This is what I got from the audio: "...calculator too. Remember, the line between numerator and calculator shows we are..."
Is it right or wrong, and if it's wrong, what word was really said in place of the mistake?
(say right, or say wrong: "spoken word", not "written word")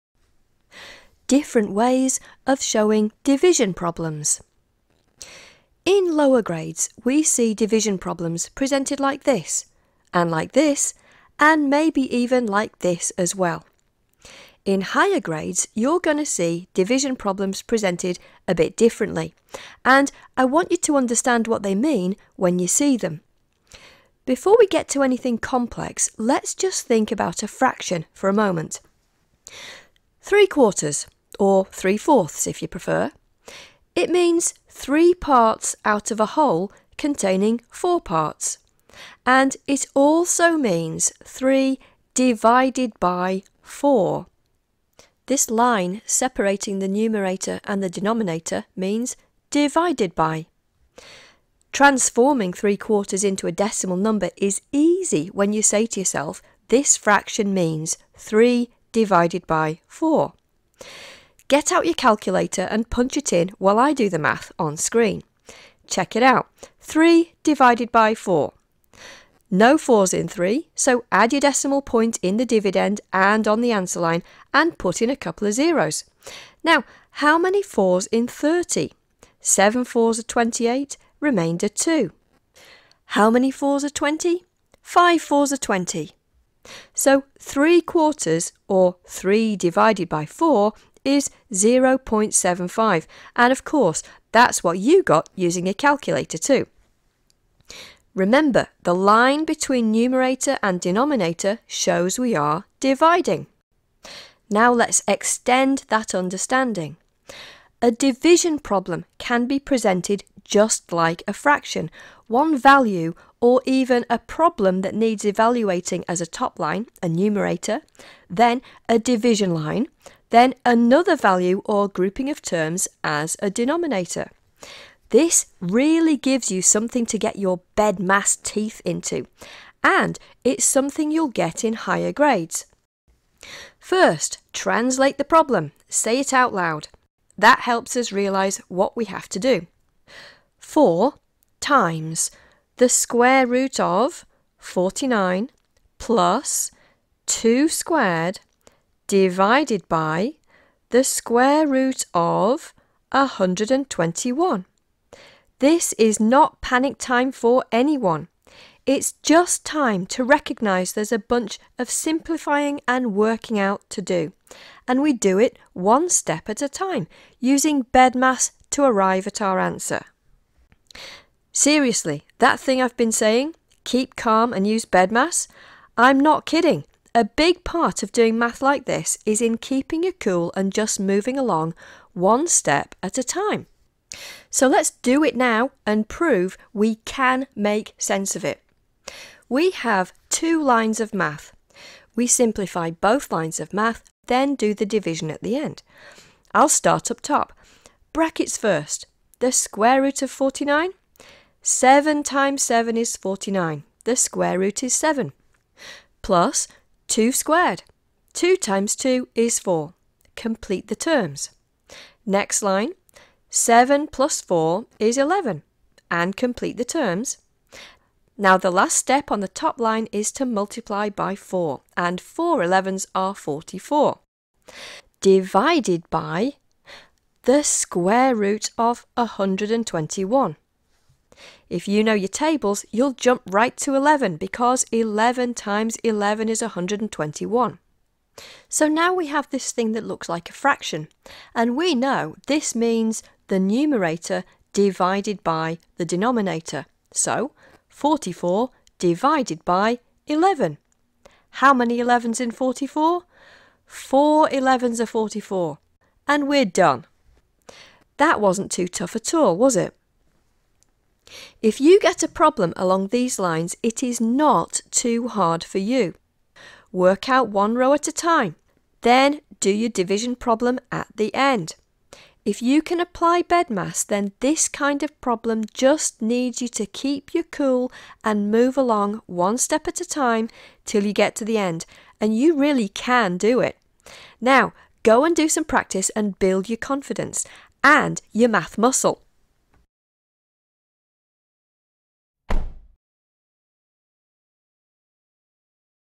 wrong: "denominator", not "calculator".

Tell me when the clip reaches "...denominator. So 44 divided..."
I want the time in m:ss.
4:06.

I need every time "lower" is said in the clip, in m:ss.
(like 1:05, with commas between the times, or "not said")
0:06.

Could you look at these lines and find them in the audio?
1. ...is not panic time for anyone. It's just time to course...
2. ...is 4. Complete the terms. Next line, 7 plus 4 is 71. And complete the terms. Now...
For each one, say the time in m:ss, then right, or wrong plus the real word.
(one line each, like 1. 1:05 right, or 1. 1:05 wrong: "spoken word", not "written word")
1. 2:35 wrong: "recognise", not "course"
2. 3:29 wrong: "11", not "71".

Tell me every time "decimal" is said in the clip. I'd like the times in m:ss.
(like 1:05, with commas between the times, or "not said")
0:53, 1:11.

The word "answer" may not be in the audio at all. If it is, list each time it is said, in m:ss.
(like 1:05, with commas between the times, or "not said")
1:13, 2:49.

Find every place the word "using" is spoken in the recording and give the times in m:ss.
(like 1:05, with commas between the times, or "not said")
1:35, 2:47.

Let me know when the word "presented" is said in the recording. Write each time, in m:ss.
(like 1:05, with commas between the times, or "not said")
0:08, 0:17, 1:49.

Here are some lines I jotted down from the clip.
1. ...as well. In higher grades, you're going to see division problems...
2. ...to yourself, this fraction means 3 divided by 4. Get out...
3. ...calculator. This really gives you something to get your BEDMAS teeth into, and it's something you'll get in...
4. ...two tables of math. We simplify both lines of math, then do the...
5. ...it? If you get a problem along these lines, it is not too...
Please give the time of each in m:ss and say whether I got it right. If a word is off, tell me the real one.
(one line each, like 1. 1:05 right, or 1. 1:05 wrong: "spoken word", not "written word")
1. 0:13 right
2. 0:55 right
3. 2:03 wrong: "denominator", not "calculator"
4. 3:10 wrong: "lines", not "tables"
5. 4:19 right.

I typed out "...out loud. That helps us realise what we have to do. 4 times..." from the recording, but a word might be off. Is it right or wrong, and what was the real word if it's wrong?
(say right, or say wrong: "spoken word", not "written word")
right.